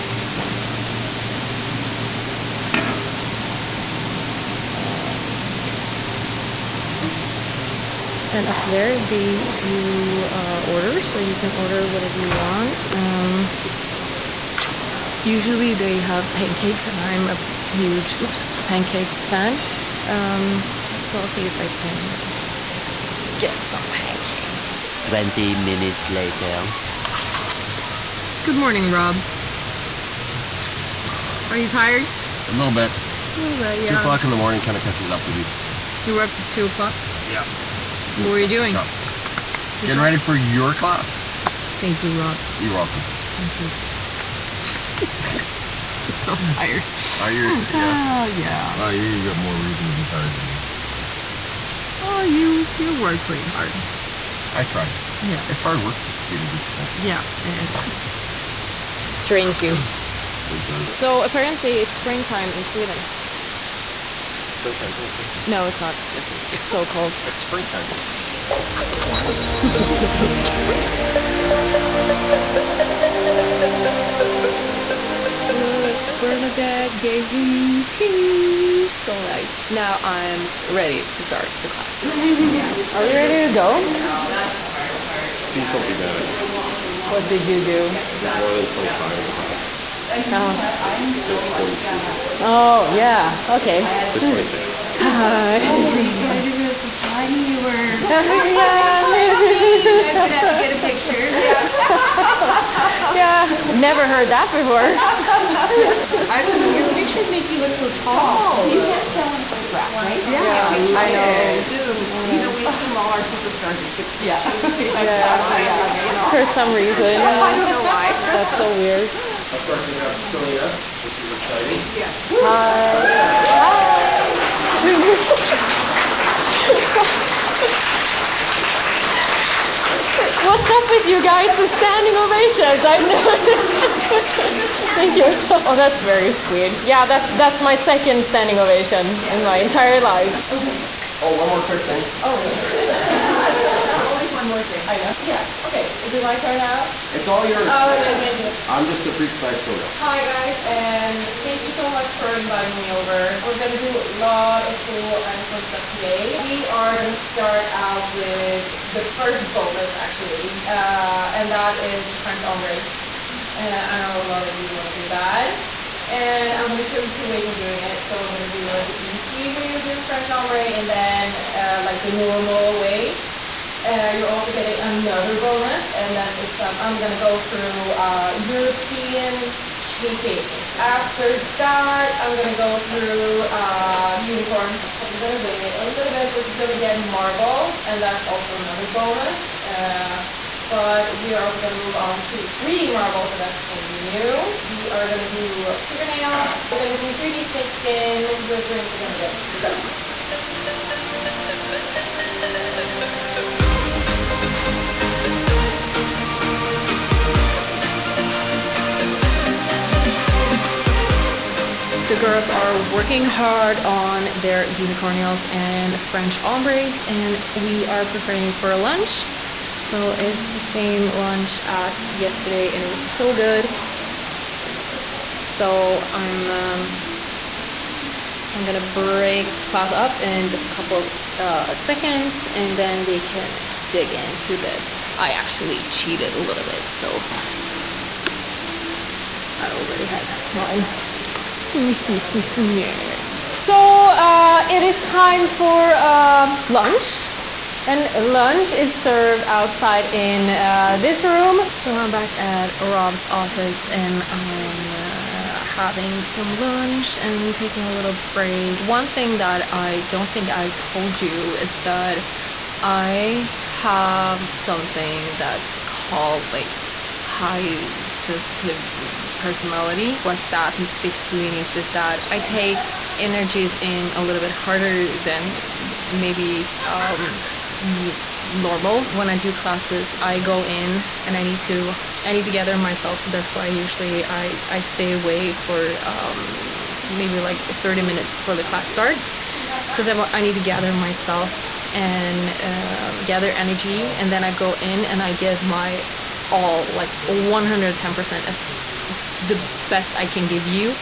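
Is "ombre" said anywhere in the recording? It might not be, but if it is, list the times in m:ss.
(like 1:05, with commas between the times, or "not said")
2:42, 2:50, 3:36.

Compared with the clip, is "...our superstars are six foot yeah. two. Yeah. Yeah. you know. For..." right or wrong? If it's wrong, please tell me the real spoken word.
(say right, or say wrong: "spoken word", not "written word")
right.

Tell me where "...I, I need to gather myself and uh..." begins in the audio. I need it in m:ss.
4:50.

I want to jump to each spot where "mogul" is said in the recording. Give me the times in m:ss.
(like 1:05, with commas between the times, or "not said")
not said.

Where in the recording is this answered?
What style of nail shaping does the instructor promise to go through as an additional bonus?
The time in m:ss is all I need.
2:58.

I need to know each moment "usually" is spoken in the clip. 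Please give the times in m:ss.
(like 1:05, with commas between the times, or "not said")
0:15, 4:43.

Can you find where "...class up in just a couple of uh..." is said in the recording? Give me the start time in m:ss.
3:49.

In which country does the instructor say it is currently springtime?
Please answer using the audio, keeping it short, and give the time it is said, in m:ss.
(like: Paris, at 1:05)
Sweden, at 1:02.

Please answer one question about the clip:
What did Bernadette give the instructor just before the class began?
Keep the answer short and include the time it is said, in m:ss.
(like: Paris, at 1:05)
tea, at 1:17.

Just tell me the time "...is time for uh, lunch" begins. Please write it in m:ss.
4:04.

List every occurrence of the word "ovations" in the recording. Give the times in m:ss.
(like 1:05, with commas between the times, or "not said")
2:13, 2:18.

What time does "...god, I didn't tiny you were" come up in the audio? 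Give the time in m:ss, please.
1:36.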